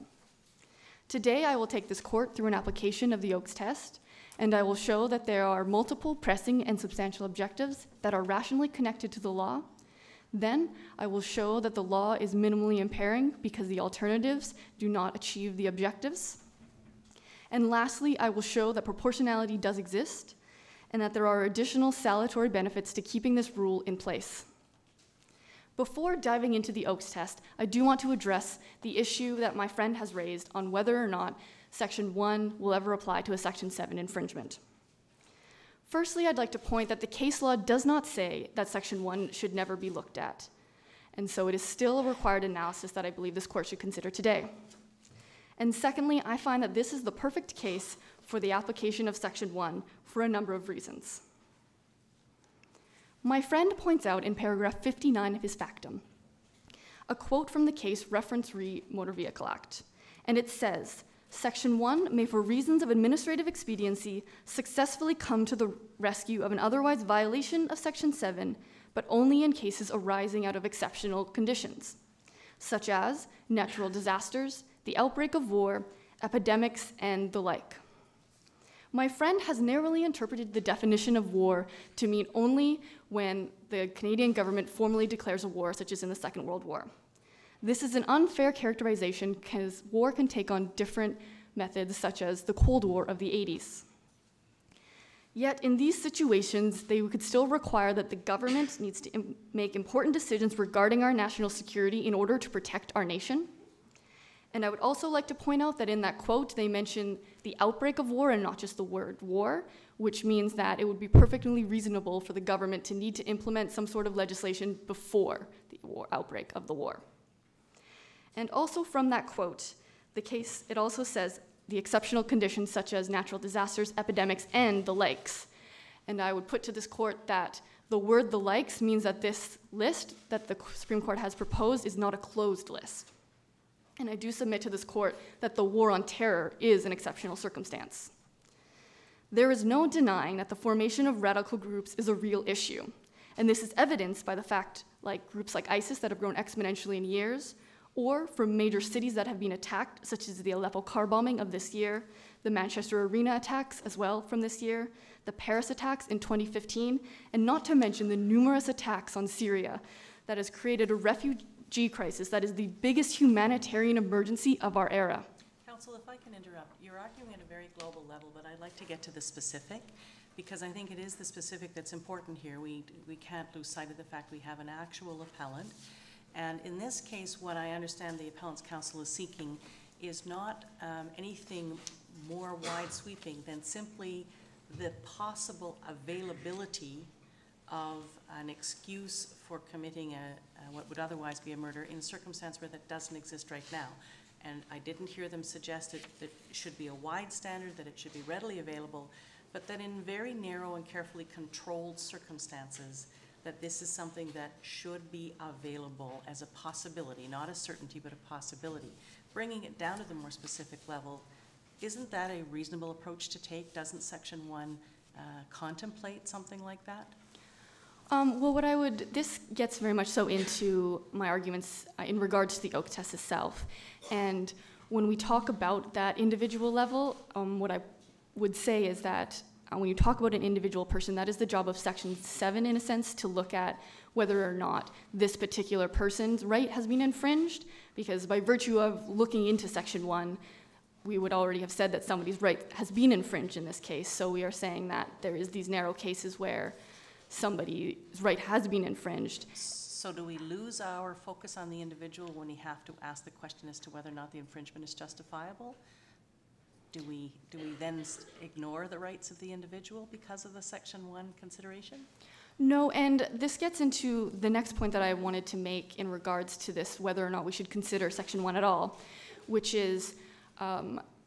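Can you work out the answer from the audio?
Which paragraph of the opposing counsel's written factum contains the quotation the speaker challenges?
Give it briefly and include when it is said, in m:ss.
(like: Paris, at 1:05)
59, at 0:54.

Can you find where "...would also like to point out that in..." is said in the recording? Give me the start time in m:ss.
1:44.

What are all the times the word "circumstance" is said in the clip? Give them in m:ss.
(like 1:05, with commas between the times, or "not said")
2:17, 3:12, 3:21.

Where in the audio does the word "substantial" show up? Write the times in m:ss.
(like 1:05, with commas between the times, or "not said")
0:06.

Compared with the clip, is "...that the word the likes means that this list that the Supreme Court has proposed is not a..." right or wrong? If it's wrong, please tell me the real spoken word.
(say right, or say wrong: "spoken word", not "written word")
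right.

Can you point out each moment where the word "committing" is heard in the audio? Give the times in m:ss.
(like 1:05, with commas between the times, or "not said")
3:09.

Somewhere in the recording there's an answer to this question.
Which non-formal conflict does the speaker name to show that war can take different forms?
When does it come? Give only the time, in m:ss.
1:32.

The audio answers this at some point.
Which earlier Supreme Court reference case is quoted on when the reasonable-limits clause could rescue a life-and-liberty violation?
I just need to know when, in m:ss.
0:58.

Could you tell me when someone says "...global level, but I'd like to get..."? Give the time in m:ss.
2:47.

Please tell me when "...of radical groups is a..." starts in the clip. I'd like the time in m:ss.
2:21.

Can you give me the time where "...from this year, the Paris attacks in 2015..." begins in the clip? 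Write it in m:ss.
2:34.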